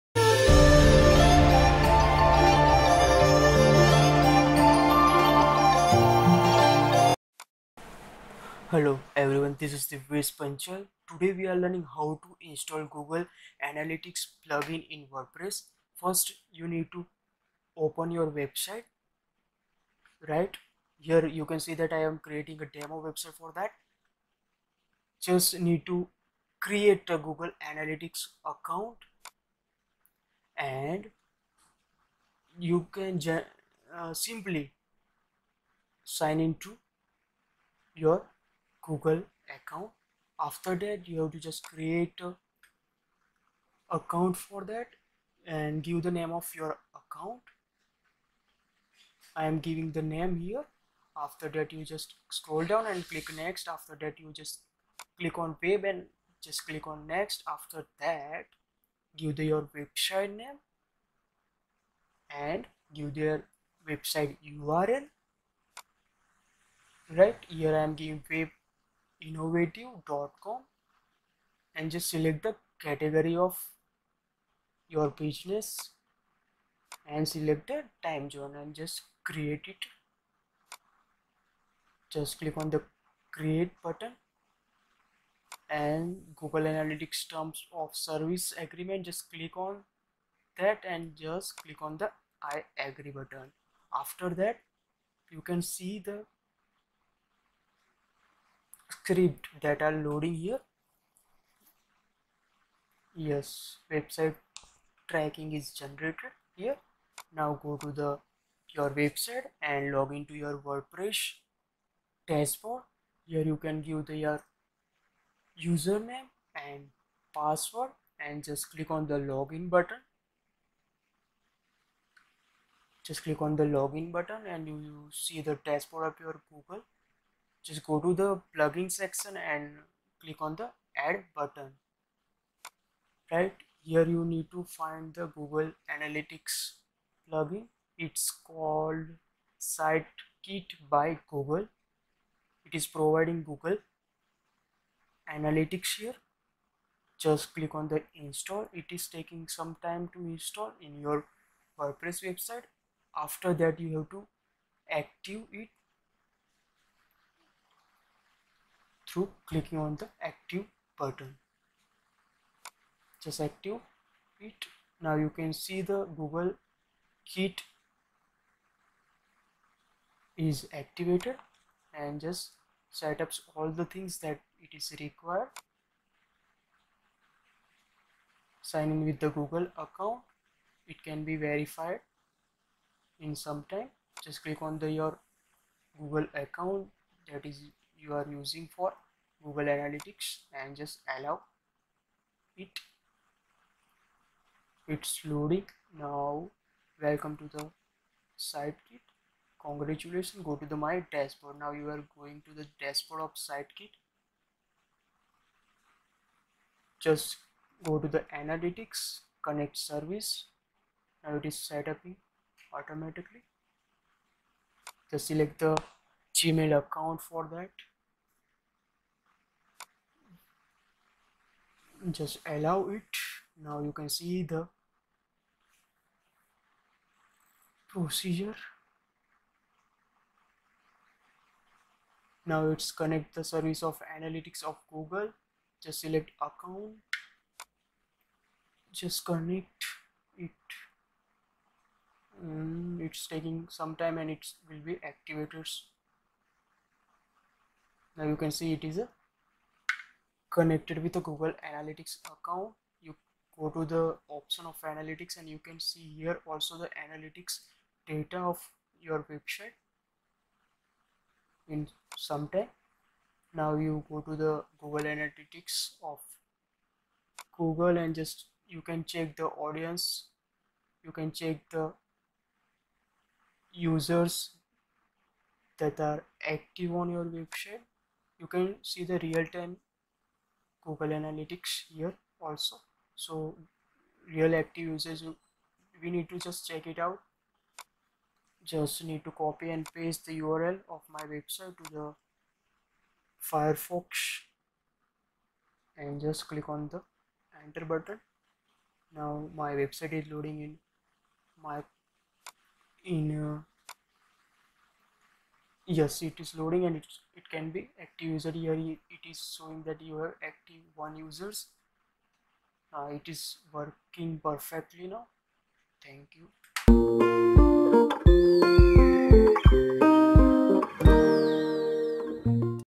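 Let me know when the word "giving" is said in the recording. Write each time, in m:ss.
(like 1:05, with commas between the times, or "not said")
0:49, 1:08.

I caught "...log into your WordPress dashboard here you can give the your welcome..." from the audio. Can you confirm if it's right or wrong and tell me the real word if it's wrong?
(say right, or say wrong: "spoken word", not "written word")
wrong: "username", not "welcome".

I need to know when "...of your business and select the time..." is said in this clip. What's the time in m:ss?
1:13.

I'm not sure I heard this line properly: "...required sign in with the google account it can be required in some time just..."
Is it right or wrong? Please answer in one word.
wrong.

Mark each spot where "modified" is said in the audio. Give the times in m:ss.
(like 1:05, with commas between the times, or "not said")
not said.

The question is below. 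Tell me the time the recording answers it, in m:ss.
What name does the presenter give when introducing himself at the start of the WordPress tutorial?
0:09.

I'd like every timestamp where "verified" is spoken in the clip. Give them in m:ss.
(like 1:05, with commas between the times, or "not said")
3:01.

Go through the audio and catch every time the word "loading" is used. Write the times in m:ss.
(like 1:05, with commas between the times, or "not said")
1:39, 3:15, 5:00, 5:06.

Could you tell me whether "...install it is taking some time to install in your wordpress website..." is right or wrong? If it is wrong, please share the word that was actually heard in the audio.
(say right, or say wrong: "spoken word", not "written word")
right.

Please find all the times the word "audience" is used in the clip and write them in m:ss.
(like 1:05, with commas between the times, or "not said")
4:29.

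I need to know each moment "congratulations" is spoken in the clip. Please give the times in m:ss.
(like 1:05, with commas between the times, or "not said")
3:19.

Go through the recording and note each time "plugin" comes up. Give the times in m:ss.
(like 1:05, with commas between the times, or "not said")
0:14, 2:08, 2:17.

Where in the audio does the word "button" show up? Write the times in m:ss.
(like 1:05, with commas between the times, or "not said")
1:23, 1:33, 1:59, 2:04, 2:11, 2:40, 4:57.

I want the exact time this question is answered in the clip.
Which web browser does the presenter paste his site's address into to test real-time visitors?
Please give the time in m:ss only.
4:53.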